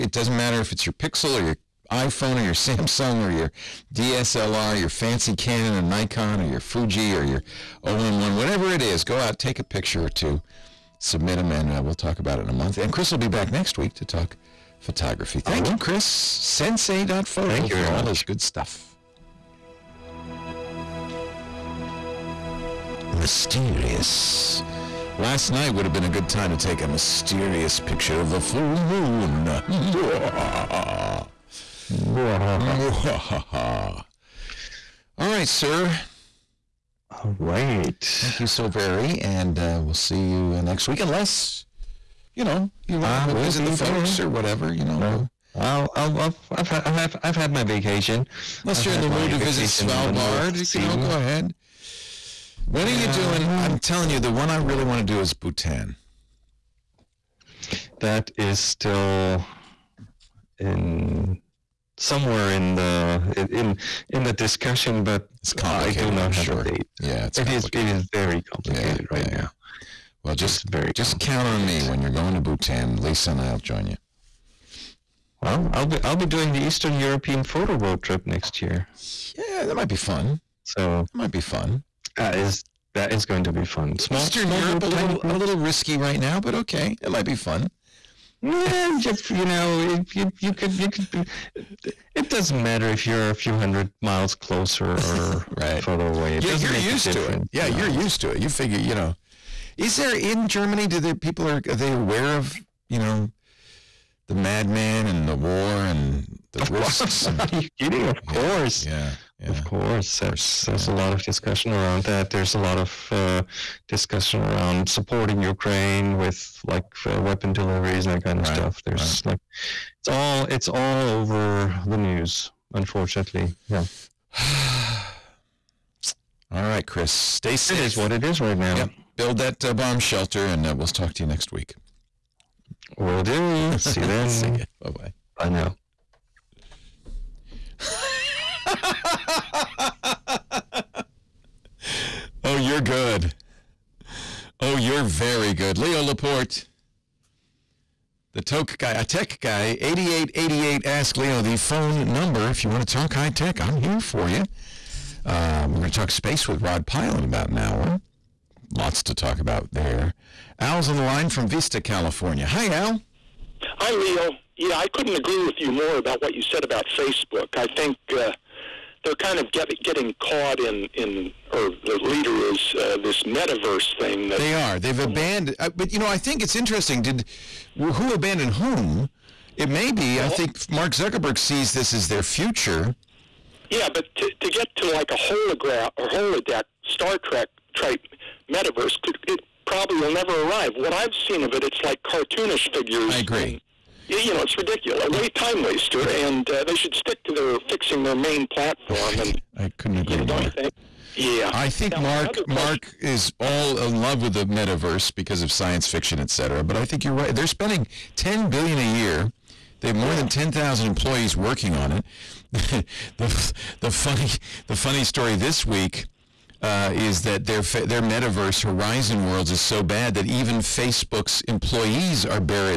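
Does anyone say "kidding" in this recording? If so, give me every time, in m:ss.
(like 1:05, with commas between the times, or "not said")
1:47.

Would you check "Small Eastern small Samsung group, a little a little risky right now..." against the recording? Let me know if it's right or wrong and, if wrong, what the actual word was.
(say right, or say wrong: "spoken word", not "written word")
wrong: "Europe", not "Samsung".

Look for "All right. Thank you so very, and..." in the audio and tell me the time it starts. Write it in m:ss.
0:37.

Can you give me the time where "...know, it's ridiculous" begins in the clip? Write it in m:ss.
3:14.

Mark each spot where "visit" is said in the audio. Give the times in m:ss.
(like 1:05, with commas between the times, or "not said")
0:43, 0:49.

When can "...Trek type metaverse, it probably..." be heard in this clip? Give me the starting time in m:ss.
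3:07.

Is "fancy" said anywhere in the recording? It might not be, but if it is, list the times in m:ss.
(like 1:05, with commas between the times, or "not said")
0:04.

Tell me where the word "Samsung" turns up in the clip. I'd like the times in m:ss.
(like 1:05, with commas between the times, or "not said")
0:02.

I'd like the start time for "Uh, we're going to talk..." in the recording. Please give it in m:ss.
2:35.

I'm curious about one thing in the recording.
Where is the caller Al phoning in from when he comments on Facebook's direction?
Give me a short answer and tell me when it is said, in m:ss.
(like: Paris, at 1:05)
Vista, California, at 2:41.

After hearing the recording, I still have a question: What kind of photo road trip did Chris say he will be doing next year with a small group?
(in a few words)
Eastern European.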